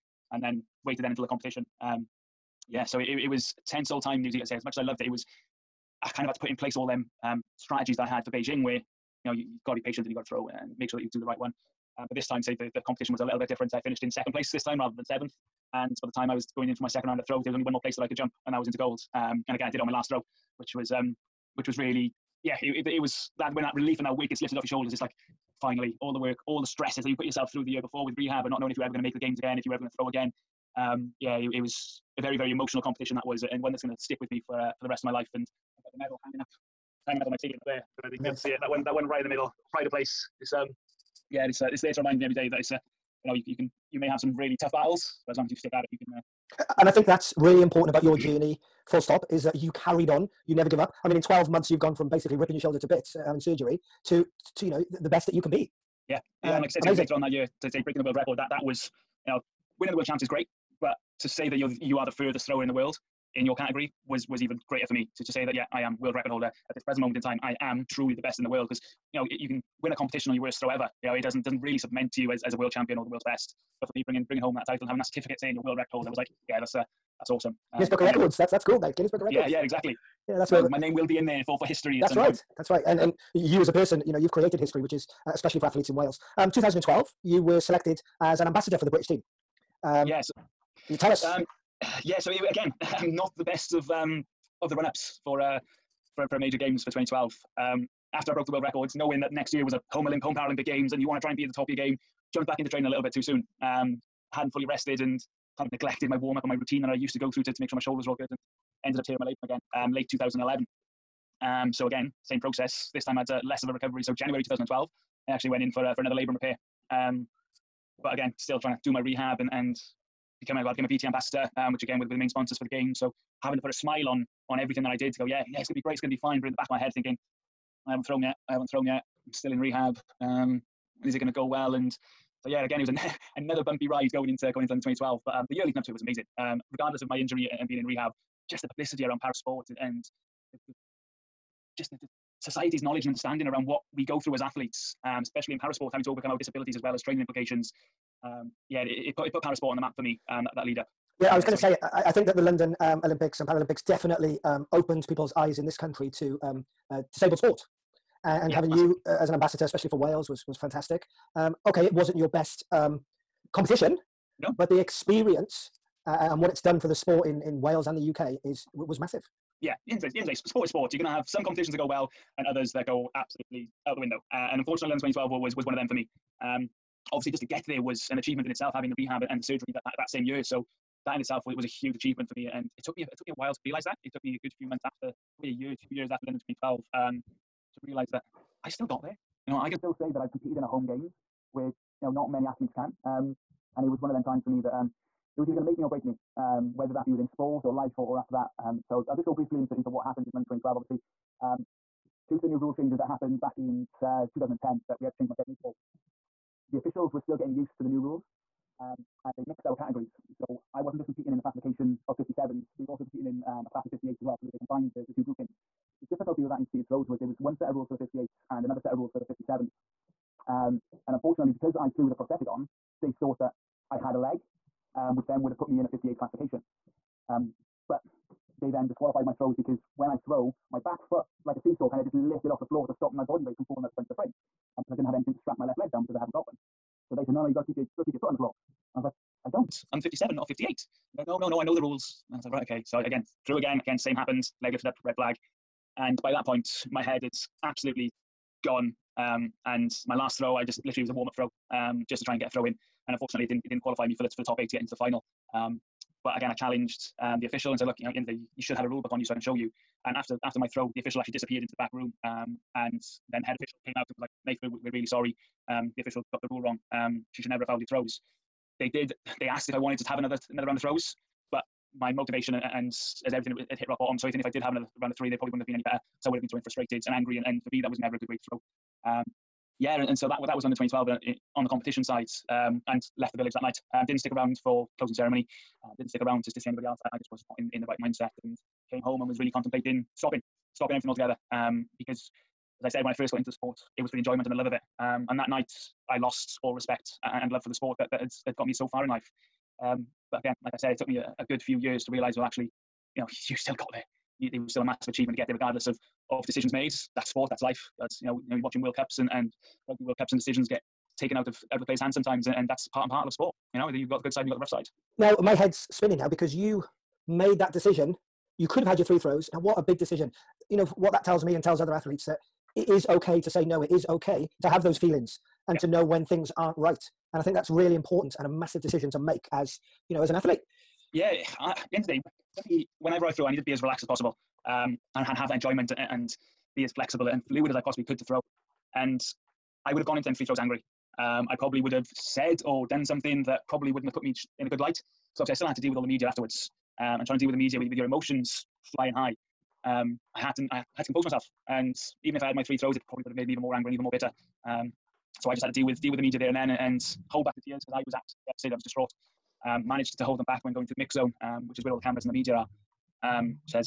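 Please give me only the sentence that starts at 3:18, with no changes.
Um, so I'll just go briefly into, into what happened in 2012.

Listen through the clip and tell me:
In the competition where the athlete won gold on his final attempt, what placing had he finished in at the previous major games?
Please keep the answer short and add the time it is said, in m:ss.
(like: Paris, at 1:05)
Seventh, at 0:15.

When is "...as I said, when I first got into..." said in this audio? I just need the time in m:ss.
4:52.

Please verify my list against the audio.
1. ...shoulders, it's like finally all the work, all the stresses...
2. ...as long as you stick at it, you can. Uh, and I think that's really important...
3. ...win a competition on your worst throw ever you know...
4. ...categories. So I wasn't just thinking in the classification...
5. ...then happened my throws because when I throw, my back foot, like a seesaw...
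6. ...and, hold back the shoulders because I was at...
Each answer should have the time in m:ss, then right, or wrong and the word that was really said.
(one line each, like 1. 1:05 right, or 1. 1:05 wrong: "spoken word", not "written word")
1. 0:24 right
2. 0:45 right
3. 1:09 right
4. 3:29 wrong: "competing", not "thinking"
5. 3:48 wrong: "disqualified", not "happened"
6. 5:56 wrong: "tears", not "shoulders".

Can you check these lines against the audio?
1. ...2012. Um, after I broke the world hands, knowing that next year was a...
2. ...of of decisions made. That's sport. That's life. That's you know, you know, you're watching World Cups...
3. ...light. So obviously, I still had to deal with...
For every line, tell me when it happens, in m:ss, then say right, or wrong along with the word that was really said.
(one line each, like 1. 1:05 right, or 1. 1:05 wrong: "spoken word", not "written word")
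1. 1:36 wrong: "records", not "hands"
2. 5:05 right
3. 5:44 right.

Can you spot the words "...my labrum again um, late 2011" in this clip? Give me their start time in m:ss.
1:49.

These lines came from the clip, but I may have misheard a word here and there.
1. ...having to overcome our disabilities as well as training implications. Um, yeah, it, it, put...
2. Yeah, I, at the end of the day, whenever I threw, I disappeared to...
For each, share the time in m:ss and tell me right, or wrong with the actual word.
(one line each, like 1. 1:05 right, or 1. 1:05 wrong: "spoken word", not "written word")
1. 2:25 right
2. 5:31 wrong: "needed", not "disappeared".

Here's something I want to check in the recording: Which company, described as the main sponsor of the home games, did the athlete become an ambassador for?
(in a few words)
BT.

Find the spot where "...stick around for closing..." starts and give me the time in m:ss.
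4:44.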